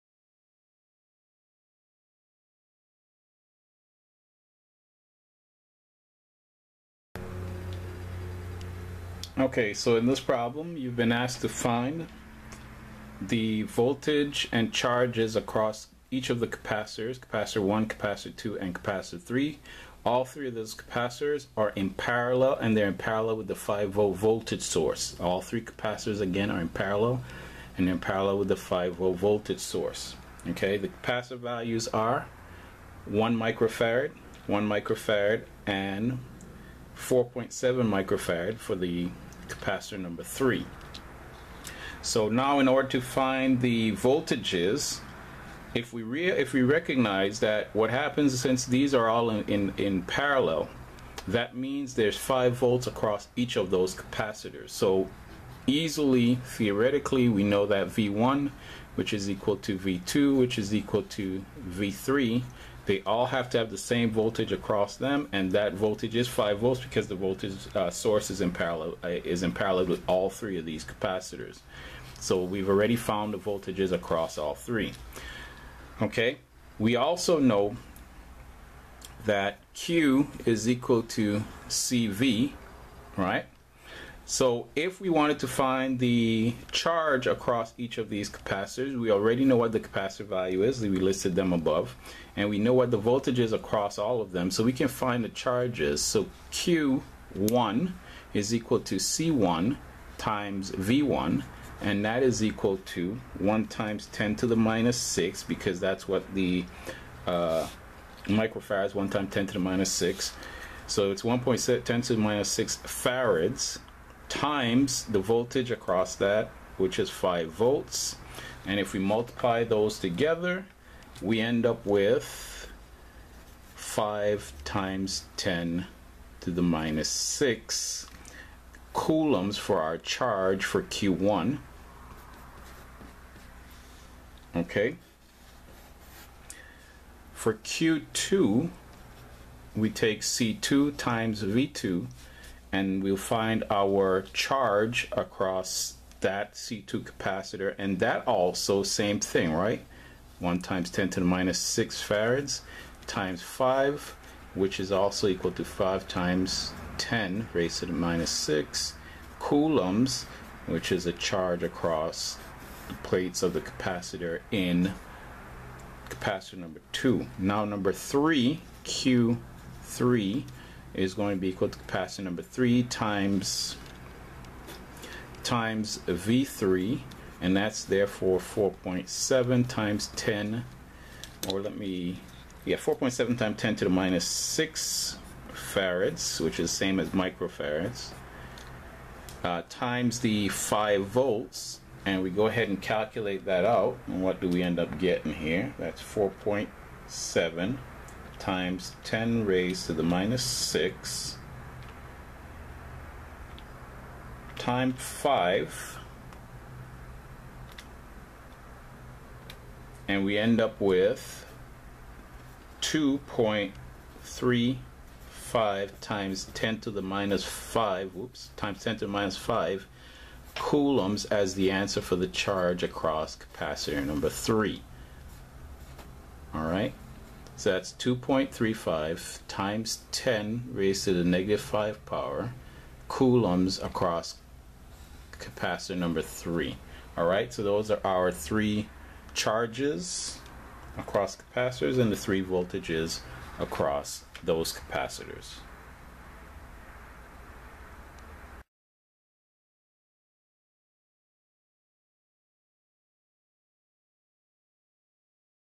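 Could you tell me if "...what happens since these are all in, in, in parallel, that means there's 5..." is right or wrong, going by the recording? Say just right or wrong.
right.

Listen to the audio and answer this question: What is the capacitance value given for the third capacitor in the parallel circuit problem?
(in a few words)
4.7 microfarads.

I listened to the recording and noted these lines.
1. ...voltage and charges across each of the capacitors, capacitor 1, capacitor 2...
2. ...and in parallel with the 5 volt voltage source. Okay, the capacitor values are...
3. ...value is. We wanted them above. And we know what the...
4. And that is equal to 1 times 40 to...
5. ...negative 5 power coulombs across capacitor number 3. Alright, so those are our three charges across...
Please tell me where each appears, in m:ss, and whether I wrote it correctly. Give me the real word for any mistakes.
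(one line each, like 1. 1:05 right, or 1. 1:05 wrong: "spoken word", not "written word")
1. 0:13 right
2. 0:27 right
3. 1:30 wrong: "listed", not "wanted"
4. 1:41 wrong: "10", not "40"
5. 3:51 right.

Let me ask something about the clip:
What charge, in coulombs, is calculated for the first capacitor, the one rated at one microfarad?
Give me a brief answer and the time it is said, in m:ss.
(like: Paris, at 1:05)
5 x 10^-6 coulombs, at 2:03.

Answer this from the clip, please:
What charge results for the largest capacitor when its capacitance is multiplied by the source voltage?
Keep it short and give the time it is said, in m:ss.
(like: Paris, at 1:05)
2.35 x 10^-5 coulombs, at 3:32.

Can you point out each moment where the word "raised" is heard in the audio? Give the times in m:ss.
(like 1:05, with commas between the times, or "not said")
2:37, 3:19, 3:50.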